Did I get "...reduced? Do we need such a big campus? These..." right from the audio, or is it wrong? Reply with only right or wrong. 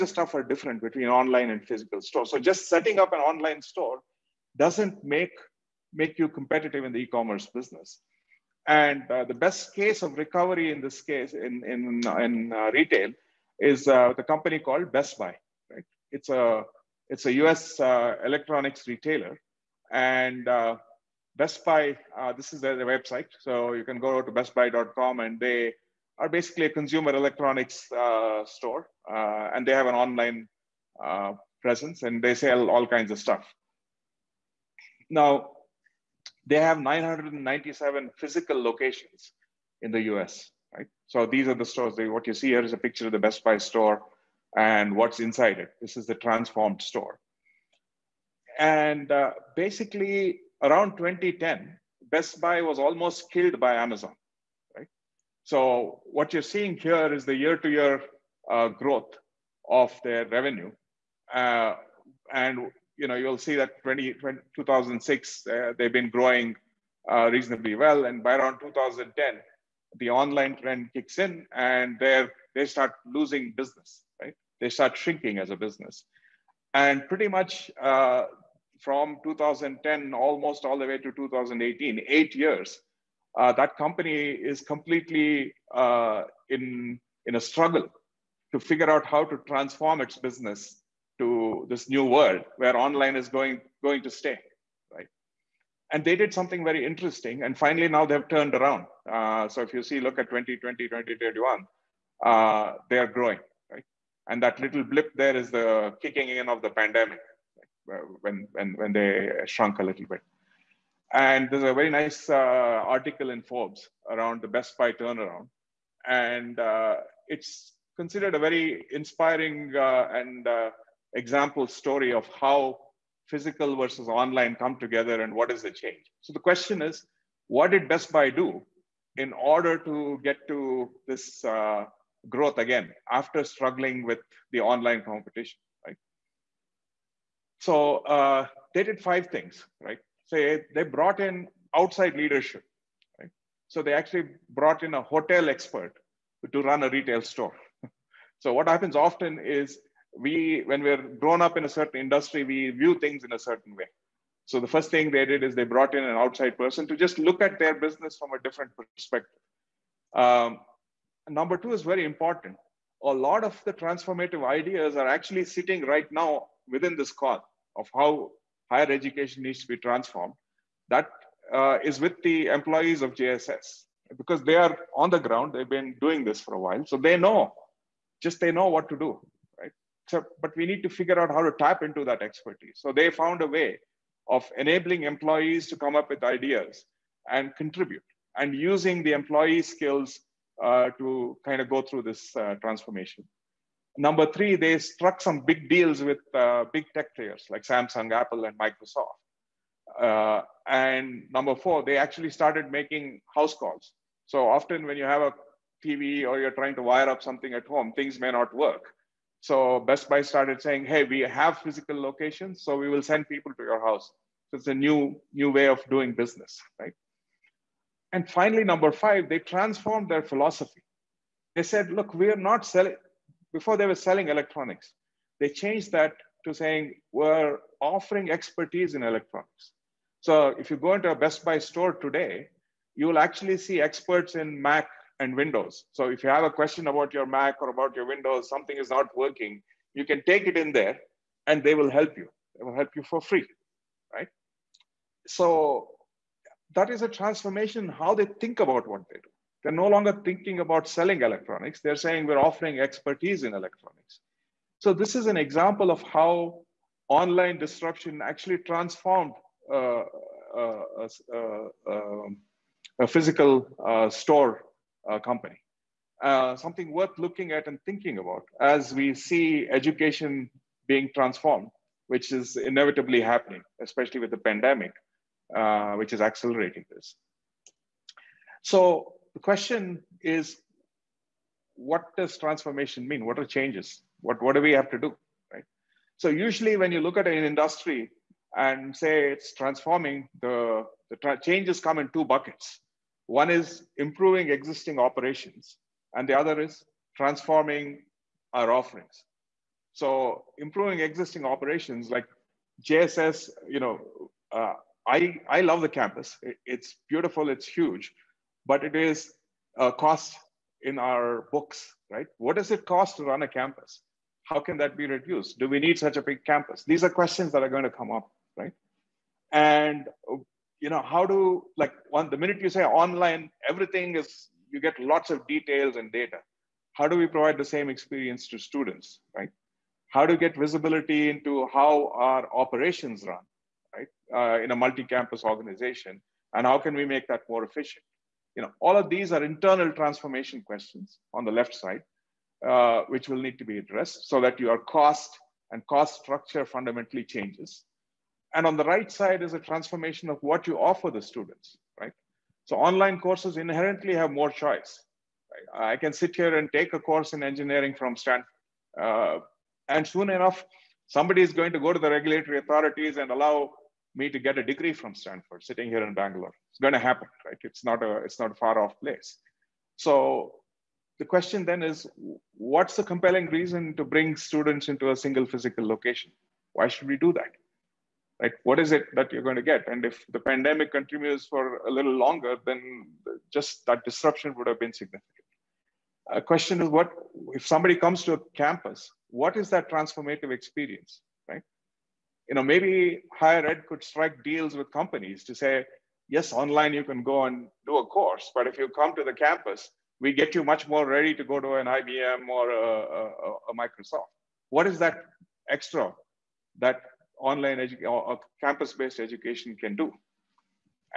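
right.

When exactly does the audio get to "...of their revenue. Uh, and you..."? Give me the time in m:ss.
0:59.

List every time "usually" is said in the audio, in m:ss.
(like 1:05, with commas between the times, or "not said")
4:46.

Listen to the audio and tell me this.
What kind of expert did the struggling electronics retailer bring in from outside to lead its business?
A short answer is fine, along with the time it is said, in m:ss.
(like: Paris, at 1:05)
A hotel expert, at 2:25.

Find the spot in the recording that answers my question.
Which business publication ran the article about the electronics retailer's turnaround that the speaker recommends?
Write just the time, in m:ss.
1:53.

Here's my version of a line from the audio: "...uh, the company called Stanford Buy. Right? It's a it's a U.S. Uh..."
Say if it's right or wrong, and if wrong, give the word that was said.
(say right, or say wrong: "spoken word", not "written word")
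wrong: "Best", not "Stanford".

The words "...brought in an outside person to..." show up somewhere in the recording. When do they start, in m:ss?
2:35.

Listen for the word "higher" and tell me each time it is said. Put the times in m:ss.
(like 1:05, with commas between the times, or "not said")
2:48, 6:33.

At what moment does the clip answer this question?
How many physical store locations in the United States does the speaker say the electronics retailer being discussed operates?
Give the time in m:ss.
0:36.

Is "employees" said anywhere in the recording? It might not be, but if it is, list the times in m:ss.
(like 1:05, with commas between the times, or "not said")
2:52, 3:05, 3:09.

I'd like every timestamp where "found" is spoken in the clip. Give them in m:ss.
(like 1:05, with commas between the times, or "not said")
3:03.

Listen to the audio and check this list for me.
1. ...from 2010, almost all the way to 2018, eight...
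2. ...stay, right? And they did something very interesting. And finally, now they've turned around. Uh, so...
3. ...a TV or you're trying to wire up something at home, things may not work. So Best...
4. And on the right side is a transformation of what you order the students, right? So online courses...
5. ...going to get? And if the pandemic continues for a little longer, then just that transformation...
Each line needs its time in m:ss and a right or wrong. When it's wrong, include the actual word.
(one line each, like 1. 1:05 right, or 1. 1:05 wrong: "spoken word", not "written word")
1. 1:18 right
2. 1:34 right
3. 3:25 right
4. 5:48 wrong: "offer", not "order"
5. 6:19 wrong: "disruption", not "transformation".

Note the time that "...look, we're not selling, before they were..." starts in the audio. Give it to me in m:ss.
3:41.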